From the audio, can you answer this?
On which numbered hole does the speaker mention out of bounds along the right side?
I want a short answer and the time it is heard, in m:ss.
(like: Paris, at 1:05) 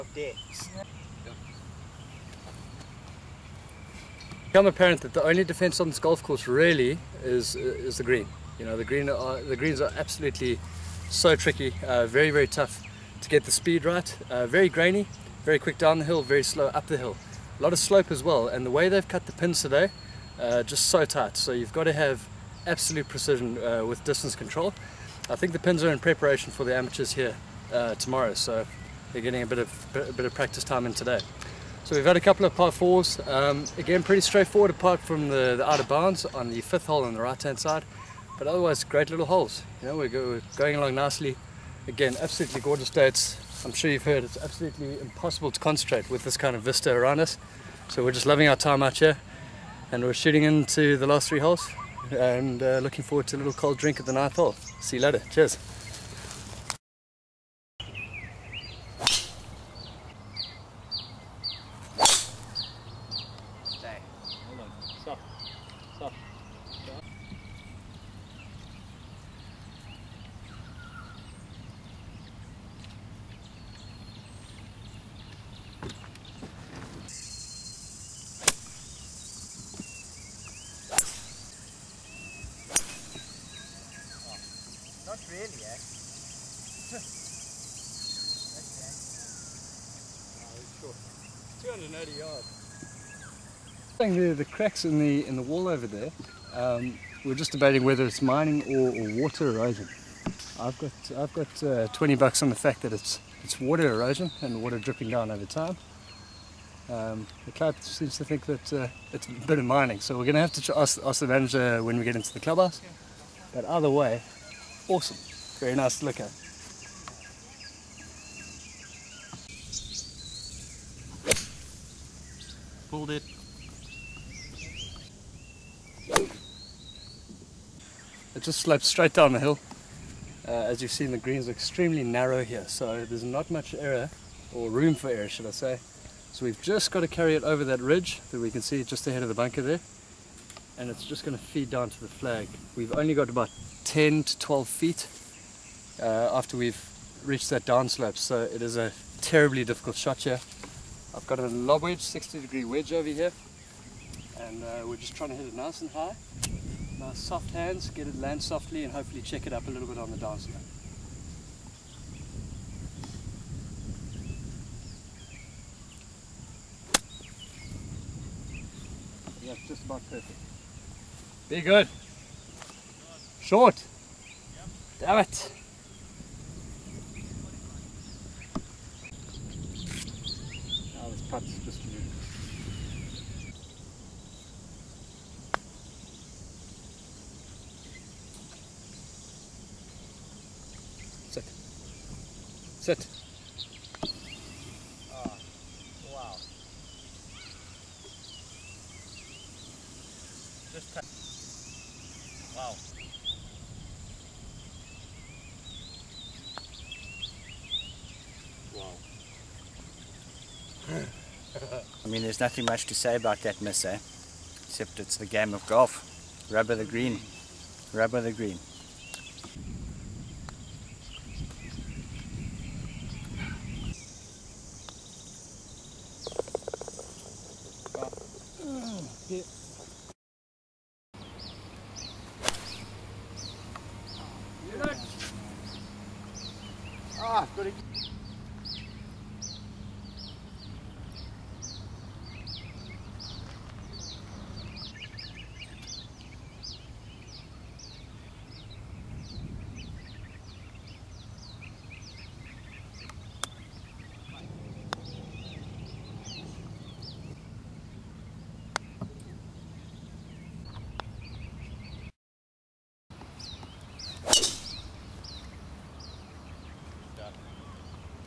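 fifth, at 0:36.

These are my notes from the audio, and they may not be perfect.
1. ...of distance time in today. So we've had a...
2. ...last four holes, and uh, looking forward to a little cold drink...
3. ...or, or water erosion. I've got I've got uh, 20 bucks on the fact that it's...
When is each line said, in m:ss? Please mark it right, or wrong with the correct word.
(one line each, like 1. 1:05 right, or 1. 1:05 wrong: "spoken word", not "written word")
1. 0:30 wrong: "practice", not "distance"
2. 0:51 wrong: "three", not "four"
3. 1:38 right.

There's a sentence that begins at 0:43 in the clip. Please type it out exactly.
It's, I'm sure you've heard it's absolutely impossible to concentrate with this kind of vista around us.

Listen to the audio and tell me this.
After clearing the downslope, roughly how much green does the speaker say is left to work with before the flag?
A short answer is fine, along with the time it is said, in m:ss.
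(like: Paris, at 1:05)
10 to 12 feet, at 2:23.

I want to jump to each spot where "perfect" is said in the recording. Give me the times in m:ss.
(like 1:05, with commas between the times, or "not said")
2:50.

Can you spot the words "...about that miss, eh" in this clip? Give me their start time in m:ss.
3:33.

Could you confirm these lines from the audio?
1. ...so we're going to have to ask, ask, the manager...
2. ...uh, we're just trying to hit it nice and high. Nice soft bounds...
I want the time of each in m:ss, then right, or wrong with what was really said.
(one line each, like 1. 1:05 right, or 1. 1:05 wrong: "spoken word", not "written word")
1. 1:50 right
2. 2:34 wrong: "hands", not "bounds".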